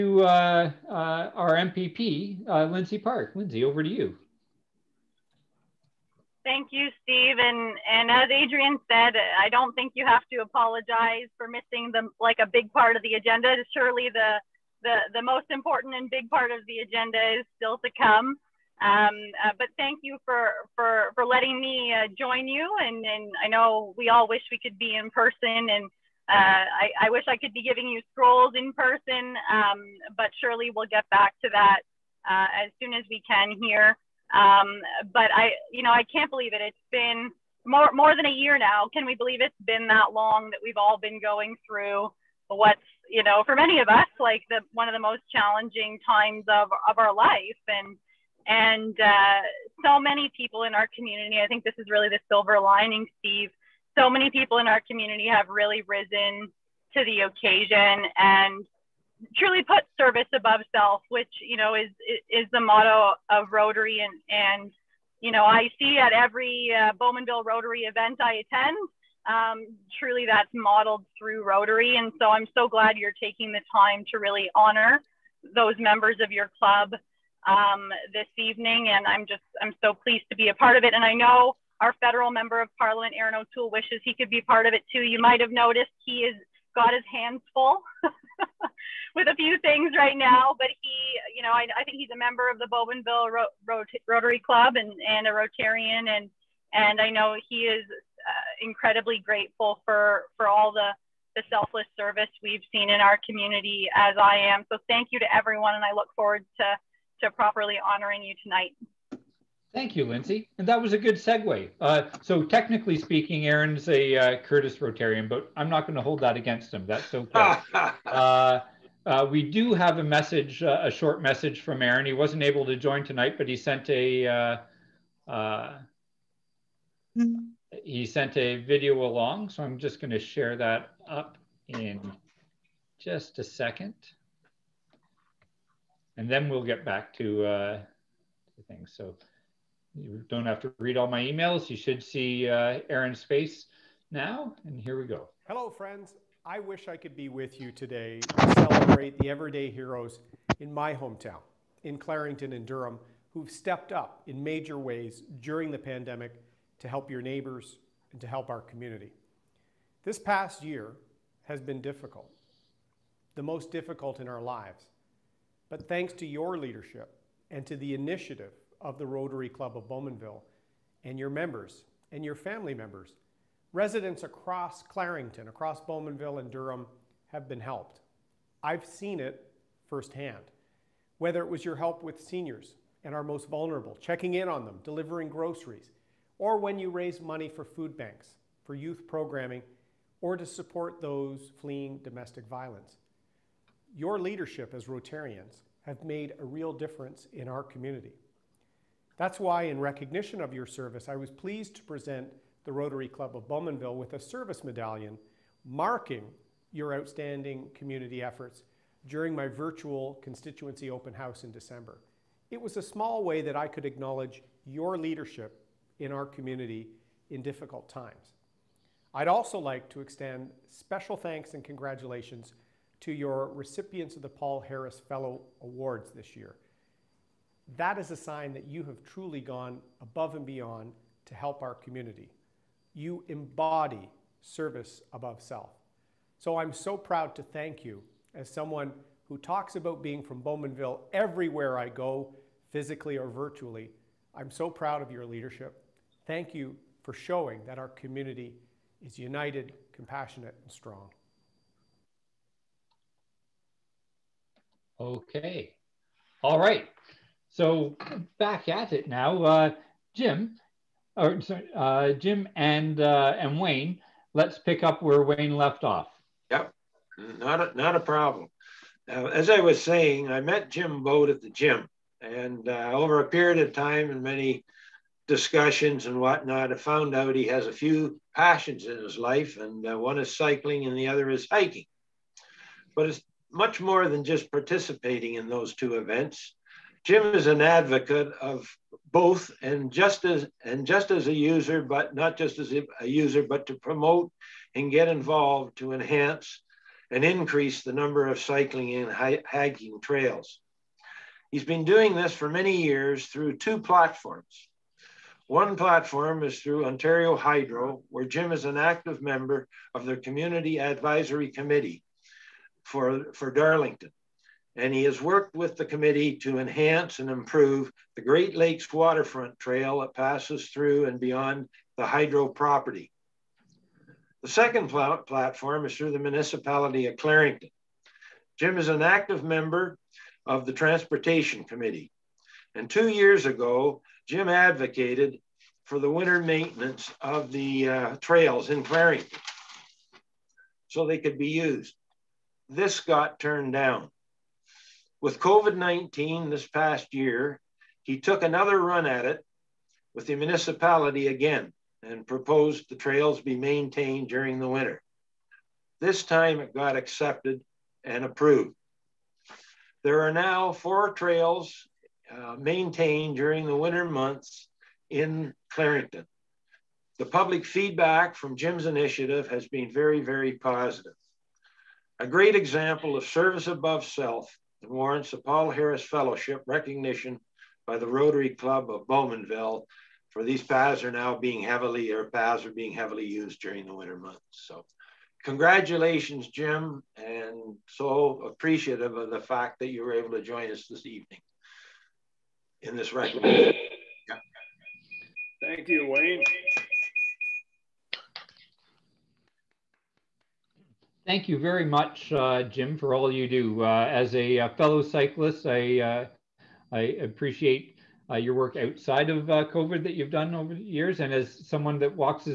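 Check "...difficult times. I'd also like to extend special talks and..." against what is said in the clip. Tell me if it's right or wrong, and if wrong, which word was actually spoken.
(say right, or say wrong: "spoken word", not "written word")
wrong: "thanks", not "talks".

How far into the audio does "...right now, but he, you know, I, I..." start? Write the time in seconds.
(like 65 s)
89 s.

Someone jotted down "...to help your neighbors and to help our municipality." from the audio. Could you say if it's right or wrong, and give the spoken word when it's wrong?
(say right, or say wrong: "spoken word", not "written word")
wrong: "community", not "municipality".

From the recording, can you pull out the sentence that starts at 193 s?
Your leadership as Rotarians have made a real difference in our community.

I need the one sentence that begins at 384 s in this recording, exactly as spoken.
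So congratulations, Jim, and so appreciative of the fact that you were able to join us this evening in this recognition.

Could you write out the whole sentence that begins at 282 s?
But it's much more than just participating in those two events.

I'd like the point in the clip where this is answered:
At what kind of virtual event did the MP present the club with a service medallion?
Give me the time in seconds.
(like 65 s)
210 s.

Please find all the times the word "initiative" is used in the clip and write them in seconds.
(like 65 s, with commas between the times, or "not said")
167 s, 368 s.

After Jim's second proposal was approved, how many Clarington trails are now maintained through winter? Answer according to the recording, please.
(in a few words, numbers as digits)
4.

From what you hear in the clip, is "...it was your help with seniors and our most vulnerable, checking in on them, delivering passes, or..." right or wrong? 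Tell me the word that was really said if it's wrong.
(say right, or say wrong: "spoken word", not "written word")
wrong: "groceries", not "passes".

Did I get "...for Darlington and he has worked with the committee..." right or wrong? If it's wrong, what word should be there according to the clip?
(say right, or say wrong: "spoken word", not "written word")
right.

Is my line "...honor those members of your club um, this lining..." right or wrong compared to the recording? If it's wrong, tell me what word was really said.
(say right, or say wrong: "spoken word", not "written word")
wrong: "evening", not "lining".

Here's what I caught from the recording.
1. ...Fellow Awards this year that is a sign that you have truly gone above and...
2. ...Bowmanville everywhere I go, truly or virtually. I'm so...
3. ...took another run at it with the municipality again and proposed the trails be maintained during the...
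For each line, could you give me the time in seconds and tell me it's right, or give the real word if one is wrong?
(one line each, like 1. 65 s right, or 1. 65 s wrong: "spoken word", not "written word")
1. 225 s right
2. 240 s wrong: "physically", not "truly"
3. 348 s right.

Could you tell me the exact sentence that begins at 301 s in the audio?
He's been doing this for many years through two platforms.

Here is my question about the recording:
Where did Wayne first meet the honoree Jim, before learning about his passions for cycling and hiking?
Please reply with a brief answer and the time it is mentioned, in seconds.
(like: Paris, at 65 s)
the gym, at 271 s.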